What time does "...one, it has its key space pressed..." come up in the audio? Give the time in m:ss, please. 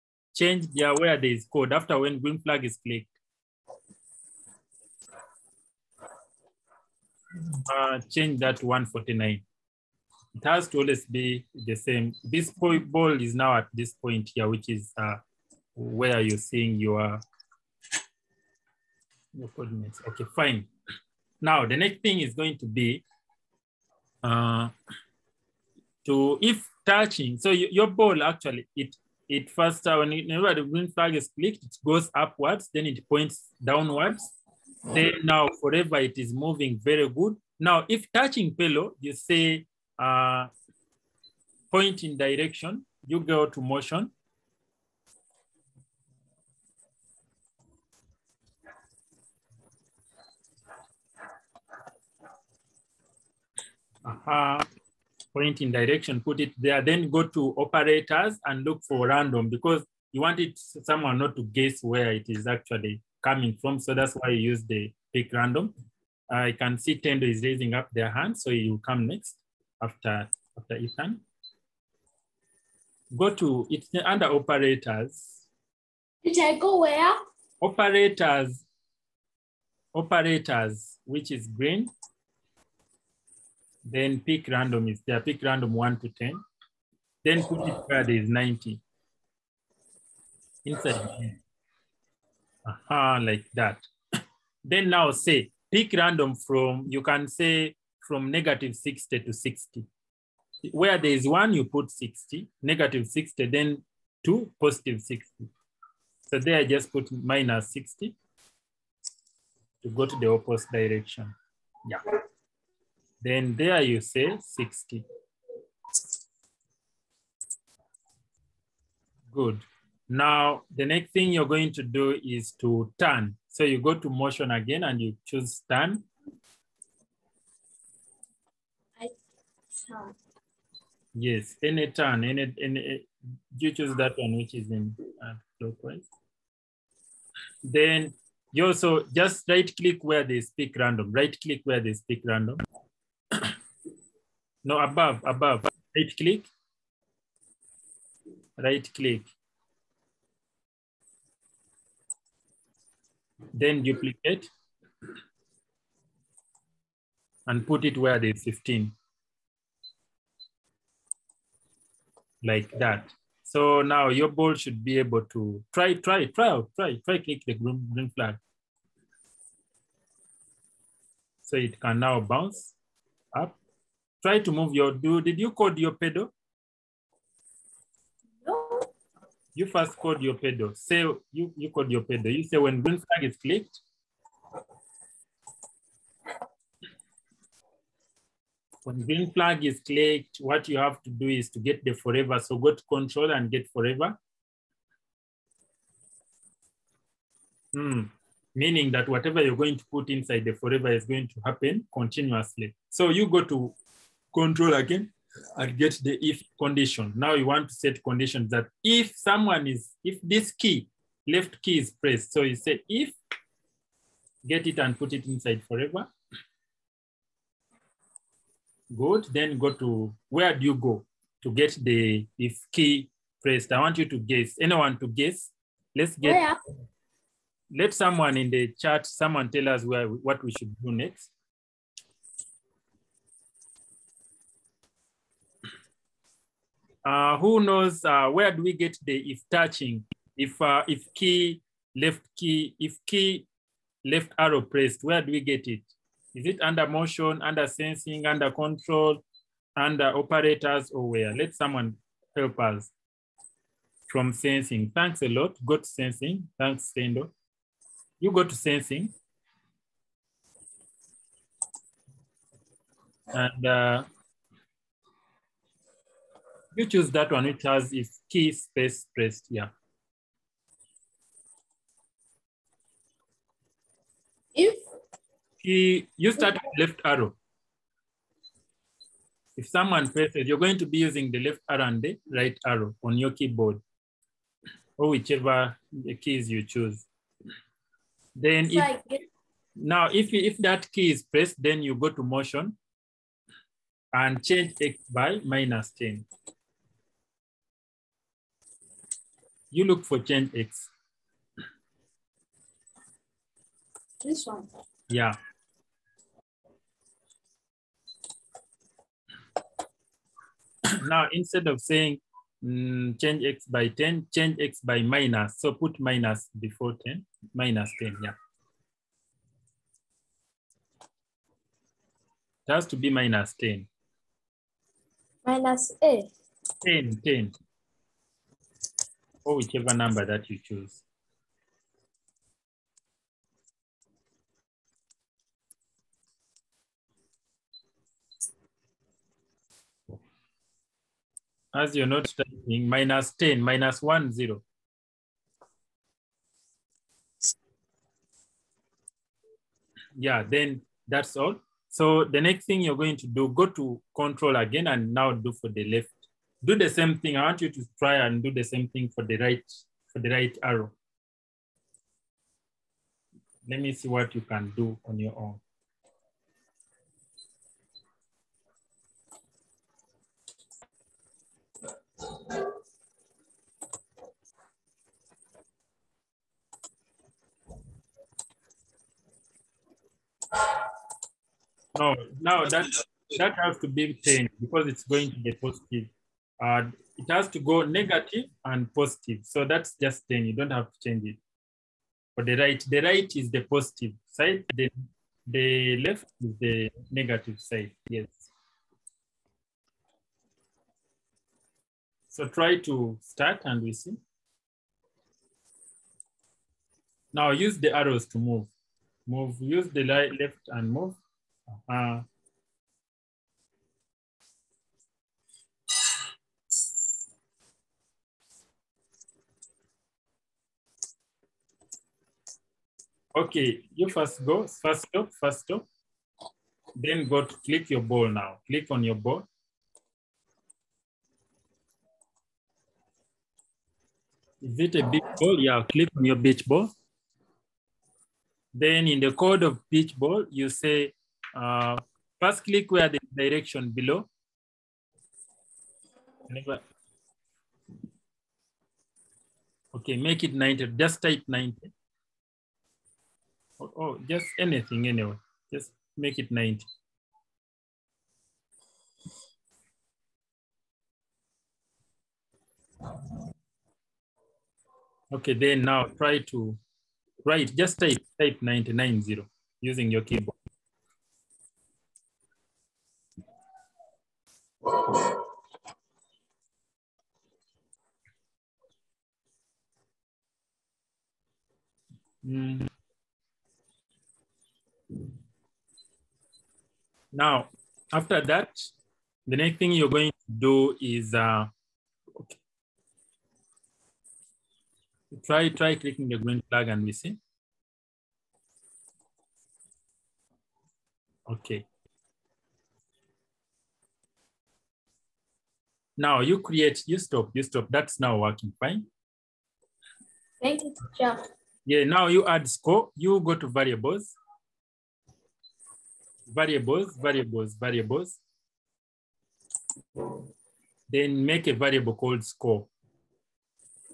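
4:27.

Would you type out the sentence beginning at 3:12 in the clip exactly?
So go to control and get forever.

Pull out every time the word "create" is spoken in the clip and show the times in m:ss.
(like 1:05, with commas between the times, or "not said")
8:26.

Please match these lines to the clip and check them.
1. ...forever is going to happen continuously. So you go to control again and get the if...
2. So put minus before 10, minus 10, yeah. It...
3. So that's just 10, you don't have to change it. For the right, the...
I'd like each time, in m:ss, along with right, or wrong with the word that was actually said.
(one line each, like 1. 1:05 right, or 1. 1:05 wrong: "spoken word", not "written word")
1. 3:20 right
2. 5:15 right
3. 6:29 right.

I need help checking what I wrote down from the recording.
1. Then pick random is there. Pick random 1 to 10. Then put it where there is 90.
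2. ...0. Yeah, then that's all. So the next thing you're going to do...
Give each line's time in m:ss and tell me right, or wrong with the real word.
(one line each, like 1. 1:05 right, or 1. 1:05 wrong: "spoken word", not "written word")
1. 1:23 right
2. 5:44 right.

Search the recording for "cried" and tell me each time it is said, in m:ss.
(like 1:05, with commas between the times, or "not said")
not said.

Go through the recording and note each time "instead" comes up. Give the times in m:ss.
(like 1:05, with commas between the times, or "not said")
5:11.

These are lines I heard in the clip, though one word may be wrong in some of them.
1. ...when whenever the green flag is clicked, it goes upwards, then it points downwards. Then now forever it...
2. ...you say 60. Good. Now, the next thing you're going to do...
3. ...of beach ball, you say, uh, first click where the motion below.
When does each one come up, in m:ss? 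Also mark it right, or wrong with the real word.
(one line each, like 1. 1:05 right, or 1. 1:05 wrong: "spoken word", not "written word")
1. 0:29 right
2. 1:53 right
3. 7:19 wrong: "direction", not "motion".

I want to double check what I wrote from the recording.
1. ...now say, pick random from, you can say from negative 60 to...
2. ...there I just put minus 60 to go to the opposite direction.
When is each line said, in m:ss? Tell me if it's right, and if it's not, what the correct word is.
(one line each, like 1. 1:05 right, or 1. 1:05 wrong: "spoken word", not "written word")
1. 1:34 right
2. 1:46 right.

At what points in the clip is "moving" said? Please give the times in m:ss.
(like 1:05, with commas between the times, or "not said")
0:36.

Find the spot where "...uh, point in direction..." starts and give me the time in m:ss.
0:39.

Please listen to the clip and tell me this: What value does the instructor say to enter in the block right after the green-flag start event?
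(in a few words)
149.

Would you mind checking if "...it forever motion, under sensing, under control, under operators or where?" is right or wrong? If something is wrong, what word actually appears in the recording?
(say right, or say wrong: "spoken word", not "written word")
wrong: "under", not "forever".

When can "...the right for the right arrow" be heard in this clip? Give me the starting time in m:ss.
5:59.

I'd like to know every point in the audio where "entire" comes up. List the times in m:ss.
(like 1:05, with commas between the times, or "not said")
not said.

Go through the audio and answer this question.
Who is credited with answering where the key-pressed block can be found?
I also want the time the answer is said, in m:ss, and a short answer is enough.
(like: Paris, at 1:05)
Sendo, at 4:16.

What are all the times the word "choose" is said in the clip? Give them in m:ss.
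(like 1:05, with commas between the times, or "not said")
2:05, 2:13, 4:26, 4:46, 5:30.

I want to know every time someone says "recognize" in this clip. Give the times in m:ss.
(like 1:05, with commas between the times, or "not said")
not said.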